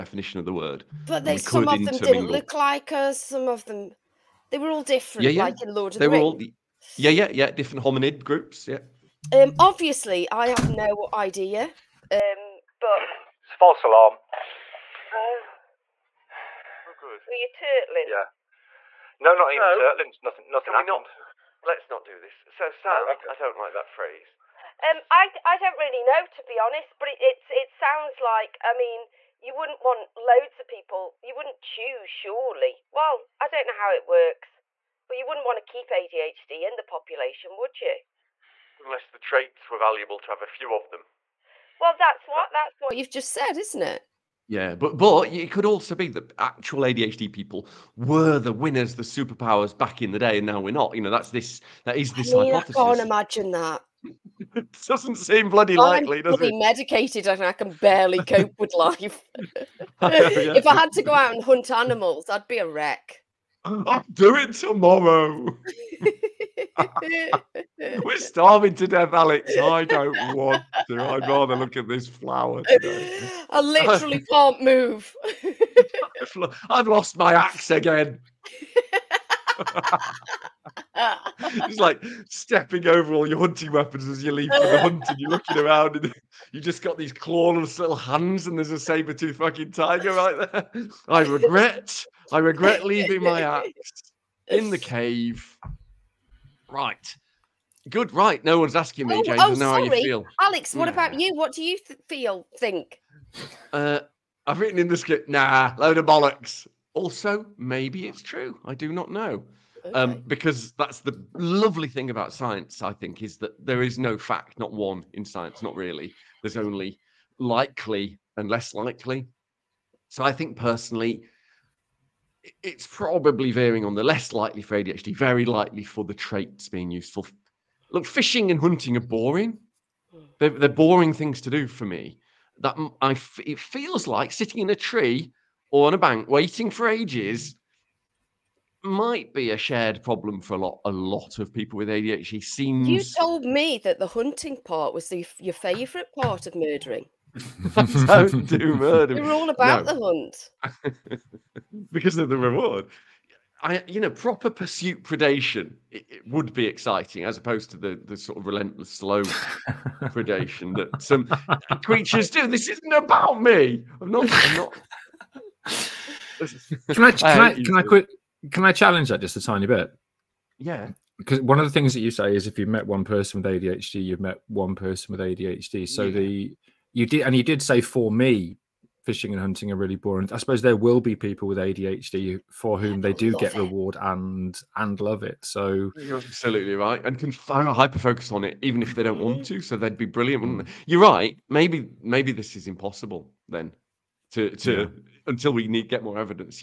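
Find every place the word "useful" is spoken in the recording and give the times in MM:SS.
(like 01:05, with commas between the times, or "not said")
02:06.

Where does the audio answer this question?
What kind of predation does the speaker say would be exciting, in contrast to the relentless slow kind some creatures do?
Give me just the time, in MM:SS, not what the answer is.
02:34.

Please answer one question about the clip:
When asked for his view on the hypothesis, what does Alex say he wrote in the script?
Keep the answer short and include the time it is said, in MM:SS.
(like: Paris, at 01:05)
Nah, load of bollocks, at 01:45.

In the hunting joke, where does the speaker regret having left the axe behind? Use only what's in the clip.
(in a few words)
In the cave.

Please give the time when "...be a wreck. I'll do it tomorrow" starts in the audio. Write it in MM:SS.
01:02.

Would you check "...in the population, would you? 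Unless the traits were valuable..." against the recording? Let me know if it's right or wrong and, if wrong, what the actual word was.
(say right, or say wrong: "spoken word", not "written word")
right.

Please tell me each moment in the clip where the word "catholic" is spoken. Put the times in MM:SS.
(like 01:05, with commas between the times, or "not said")
not said.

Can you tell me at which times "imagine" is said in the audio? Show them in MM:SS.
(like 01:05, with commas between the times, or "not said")
00:52.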